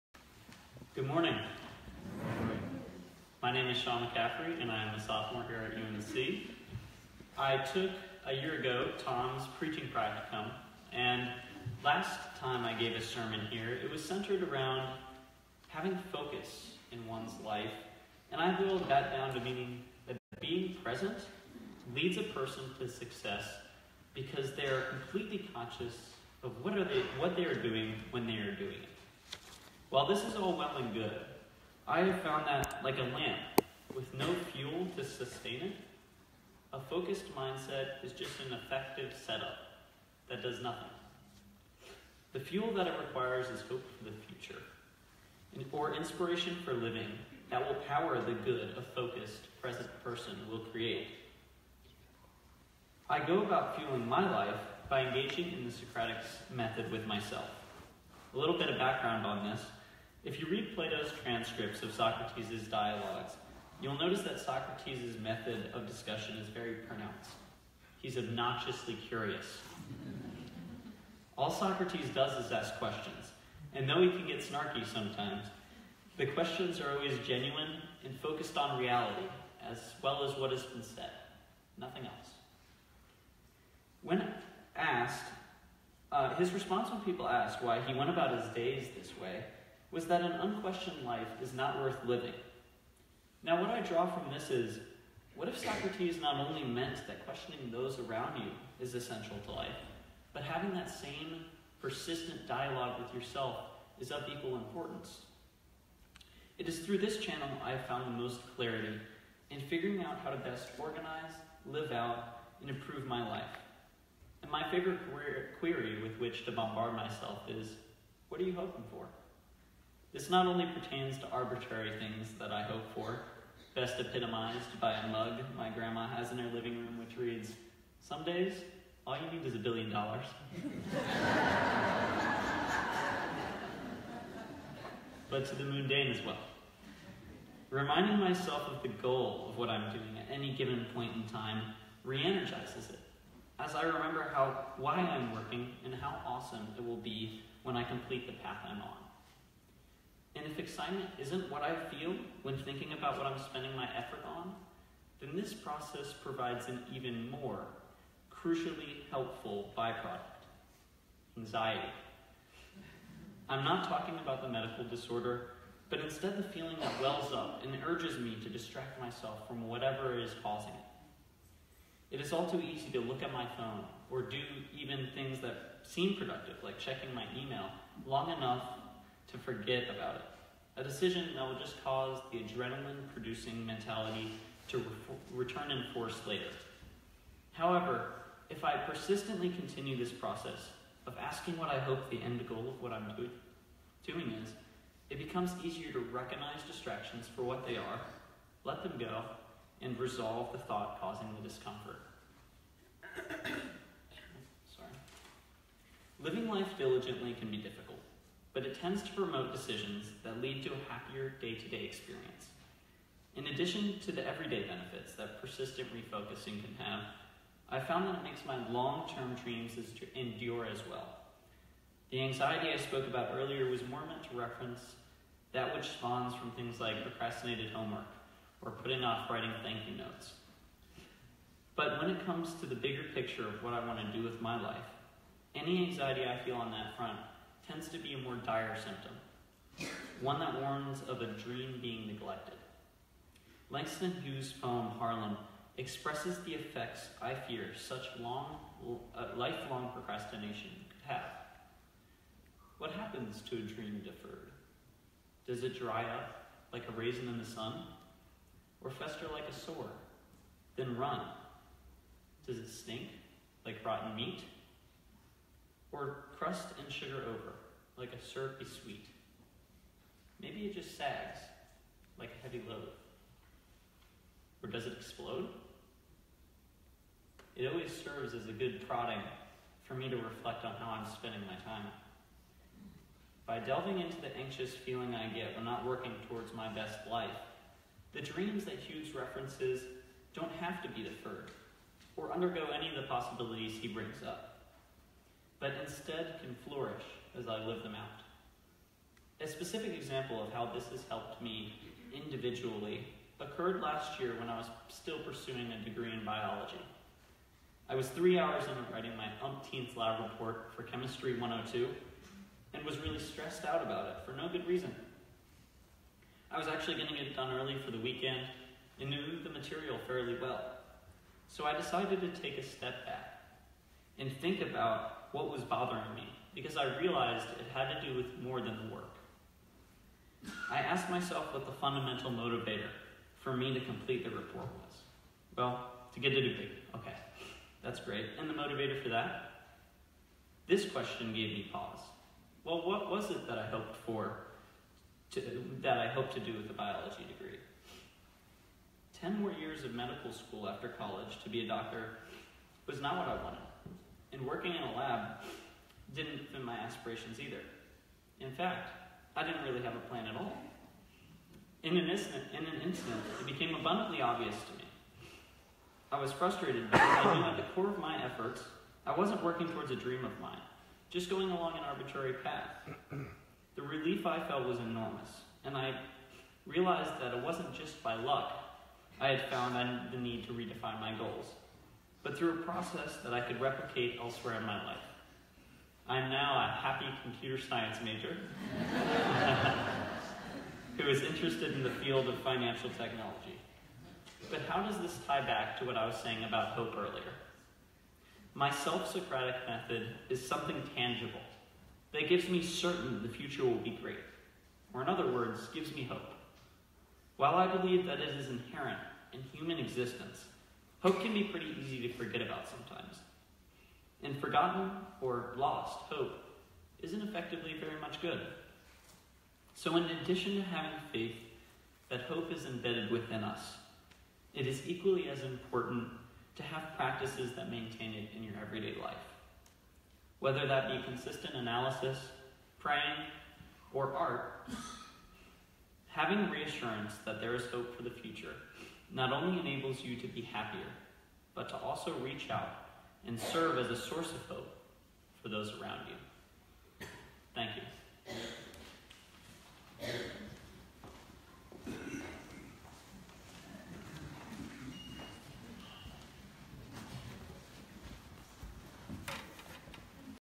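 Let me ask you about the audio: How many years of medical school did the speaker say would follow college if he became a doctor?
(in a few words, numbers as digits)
10.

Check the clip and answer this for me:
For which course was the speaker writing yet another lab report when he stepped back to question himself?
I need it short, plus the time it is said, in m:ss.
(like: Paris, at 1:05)
Chemistry 102, at 5:10.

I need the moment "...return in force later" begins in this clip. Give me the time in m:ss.
3:05.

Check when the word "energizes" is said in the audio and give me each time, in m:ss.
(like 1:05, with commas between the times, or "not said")
2:22.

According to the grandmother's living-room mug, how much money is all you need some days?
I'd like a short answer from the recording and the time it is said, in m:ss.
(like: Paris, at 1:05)
a billion dollars, at 2:09.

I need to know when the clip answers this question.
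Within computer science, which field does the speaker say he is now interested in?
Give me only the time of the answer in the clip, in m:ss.
6:32.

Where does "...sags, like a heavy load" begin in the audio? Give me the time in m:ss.
4:30.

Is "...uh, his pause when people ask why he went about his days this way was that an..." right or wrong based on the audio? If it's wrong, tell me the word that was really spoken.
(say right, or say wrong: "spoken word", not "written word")
wrong: "response", not "pause".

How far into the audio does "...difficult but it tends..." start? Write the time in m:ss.
3:27.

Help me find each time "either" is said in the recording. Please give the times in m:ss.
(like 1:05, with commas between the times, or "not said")
5:57.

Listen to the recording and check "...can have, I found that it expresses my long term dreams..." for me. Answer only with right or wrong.
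wrong.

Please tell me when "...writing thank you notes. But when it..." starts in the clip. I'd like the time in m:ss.
3:49.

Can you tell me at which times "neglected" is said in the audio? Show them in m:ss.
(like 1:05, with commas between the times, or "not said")
4:02.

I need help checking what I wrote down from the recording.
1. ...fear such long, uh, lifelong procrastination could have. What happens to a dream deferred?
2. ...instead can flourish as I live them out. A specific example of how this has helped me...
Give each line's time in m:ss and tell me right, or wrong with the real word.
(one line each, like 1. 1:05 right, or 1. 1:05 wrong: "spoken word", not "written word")
1. 4:07 right
2. 4:55 right.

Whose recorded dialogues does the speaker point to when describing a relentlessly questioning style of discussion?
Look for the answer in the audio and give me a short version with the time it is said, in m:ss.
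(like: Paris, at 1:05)
Plato, at 1:00.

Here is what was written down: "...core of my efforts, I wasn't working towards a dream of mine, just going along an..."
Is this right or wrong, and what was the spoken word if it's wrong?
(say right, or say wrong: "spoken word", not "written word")
right.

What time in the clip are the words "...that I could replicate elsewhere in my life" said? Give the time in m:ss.
6:23.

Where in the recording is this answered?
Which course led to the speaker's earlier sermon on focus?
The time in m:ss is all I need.
0:08.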